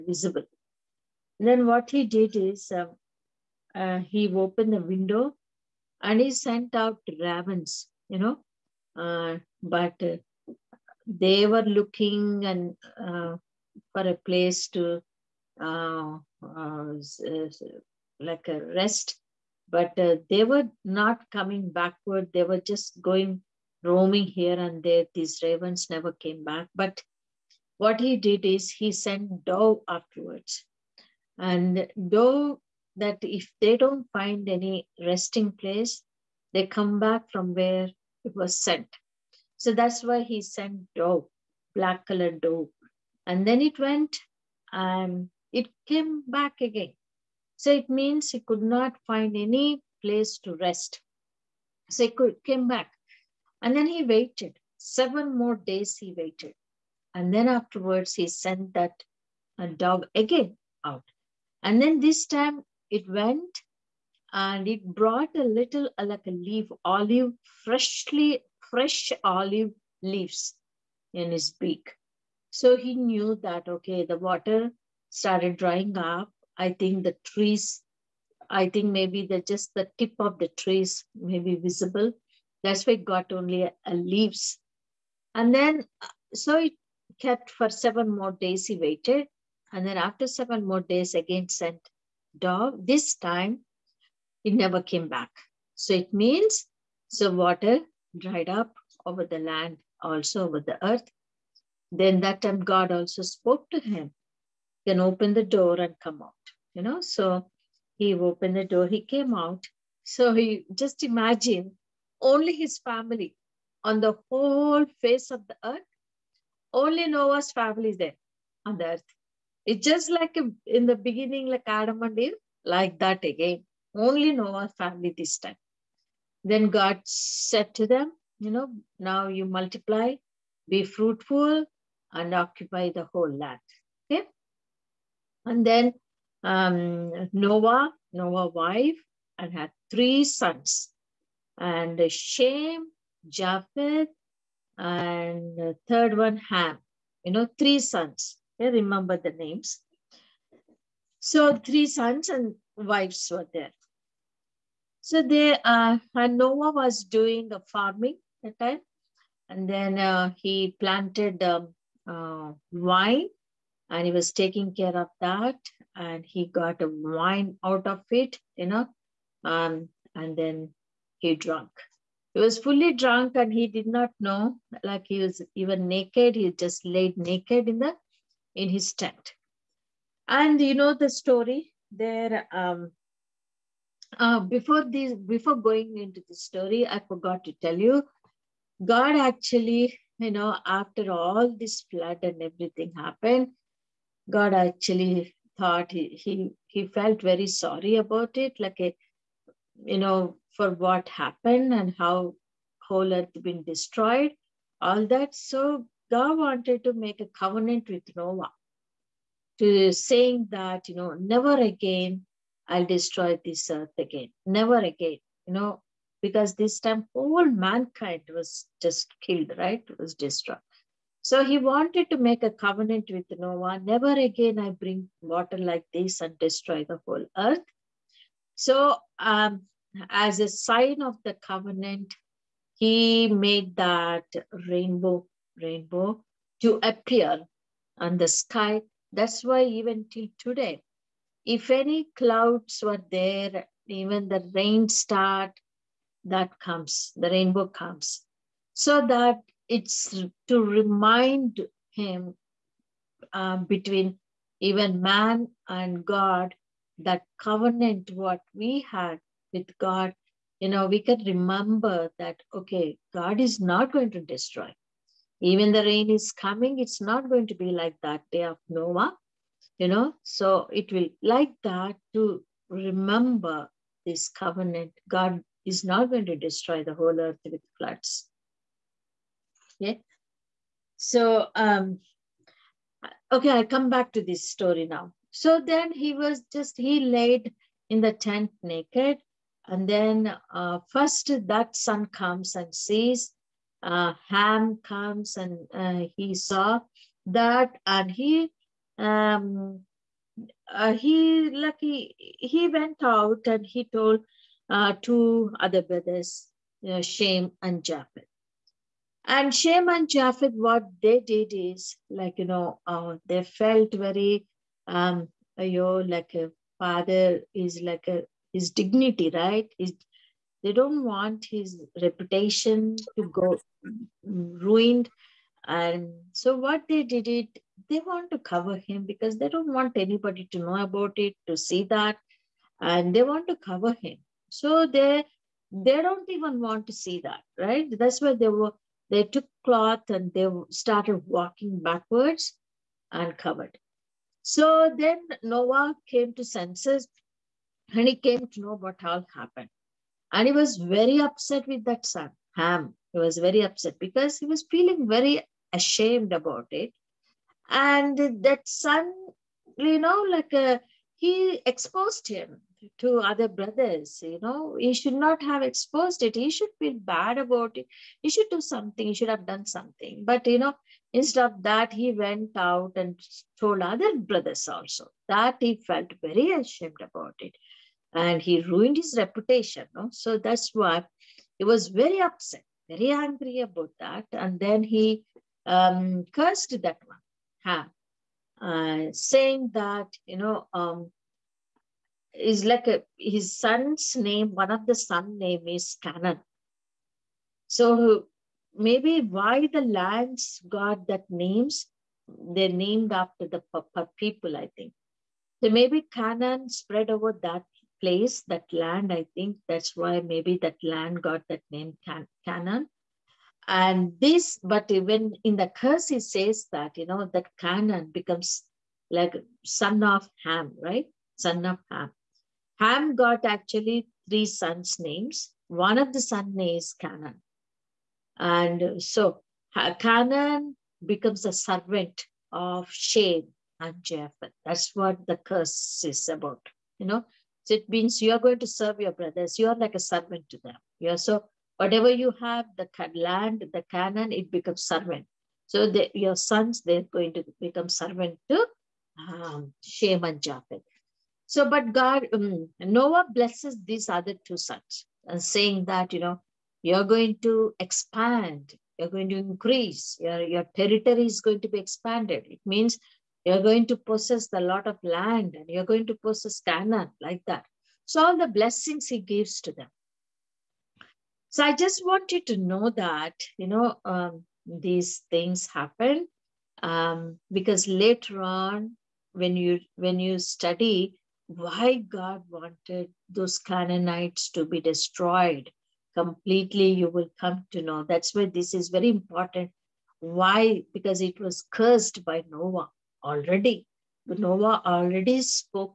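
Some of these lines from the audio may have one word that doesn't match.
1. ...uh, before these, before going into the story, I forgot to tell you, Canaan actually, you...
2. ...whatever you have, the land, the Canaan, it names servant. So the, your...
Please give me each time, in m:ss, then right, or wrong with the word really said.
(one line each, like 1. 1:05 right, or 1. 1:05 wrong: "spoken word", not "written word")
1. 3:04 wrong: "God", not "Canaan"
2. 7:21 wrong: "becomes", not "names".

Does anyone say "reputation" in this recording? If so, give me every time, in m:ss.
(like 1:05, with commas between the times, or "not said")
5:22, 6:19.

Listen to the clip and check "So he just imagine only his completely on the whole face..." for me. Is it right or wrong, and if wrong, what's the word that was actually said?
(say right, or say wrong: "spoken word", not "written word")
wrong: "family", not "completely".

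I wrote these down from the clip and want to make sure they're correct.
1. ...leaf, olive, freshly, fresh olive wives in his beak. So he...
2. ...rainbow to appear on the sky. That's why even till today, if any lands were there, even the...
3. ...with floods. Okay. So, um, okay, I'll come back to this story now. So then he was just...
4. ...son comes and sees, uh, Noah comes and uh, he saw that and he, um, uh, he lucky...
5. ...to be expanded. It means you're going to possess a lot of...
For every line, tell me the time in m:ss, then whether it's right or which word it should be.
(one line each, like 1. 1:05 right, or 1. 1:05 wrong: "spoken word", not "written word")
1. 1:06 wrong: "leaves", not "wives"
2. 3:55 wrong: "clouds", not "lands"
3. 4:37 right
4. 4:51 wrong: "Ham", not "Noah"
5. 7:41 right.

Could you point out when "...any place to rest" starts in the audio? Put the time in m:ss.
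0:49.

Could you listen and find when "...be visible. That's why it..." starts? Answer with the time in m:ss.
1:21.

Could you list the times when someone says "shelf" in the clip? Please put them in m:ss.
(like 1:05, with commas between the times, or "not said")
not said.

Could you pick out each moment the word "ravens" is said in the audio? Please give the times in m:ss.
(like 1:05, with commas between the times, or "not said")
0:07, 0:25.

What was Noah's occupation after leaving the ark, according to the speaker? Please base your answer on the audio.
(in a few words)
Farming.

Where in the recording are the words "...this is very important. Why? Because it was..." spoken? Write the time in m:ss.
8:08.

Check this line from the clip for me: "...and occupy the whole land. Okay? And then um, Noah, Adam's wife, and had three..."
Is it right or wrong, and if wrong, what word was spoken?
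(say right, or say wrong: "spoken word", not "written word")
wrong: "Noah", not "Adam".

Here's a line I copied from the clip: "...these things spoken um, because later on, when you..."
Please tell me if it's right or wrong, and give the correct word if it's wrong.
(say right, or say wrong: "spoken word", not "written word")
wrong: "happen", not "spoken".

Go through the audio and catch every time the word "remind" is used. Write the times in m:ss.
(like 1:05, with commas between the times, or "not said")
4:10.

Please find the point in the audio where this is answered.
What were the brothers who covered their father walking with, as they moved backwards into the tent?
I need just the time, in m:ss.
5:39.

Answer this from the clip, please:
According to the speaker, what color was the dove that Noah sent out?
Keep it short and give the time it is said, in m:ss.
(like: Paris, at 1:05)
Black, at 0:41.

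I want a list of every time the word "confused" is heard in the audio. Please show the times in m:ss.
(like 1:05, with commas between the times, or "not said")
not said.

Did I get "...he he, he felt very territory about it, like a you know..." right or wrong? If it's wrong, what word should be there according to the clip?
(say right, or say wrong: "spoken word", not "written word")
wrong: "sorry", not "territory".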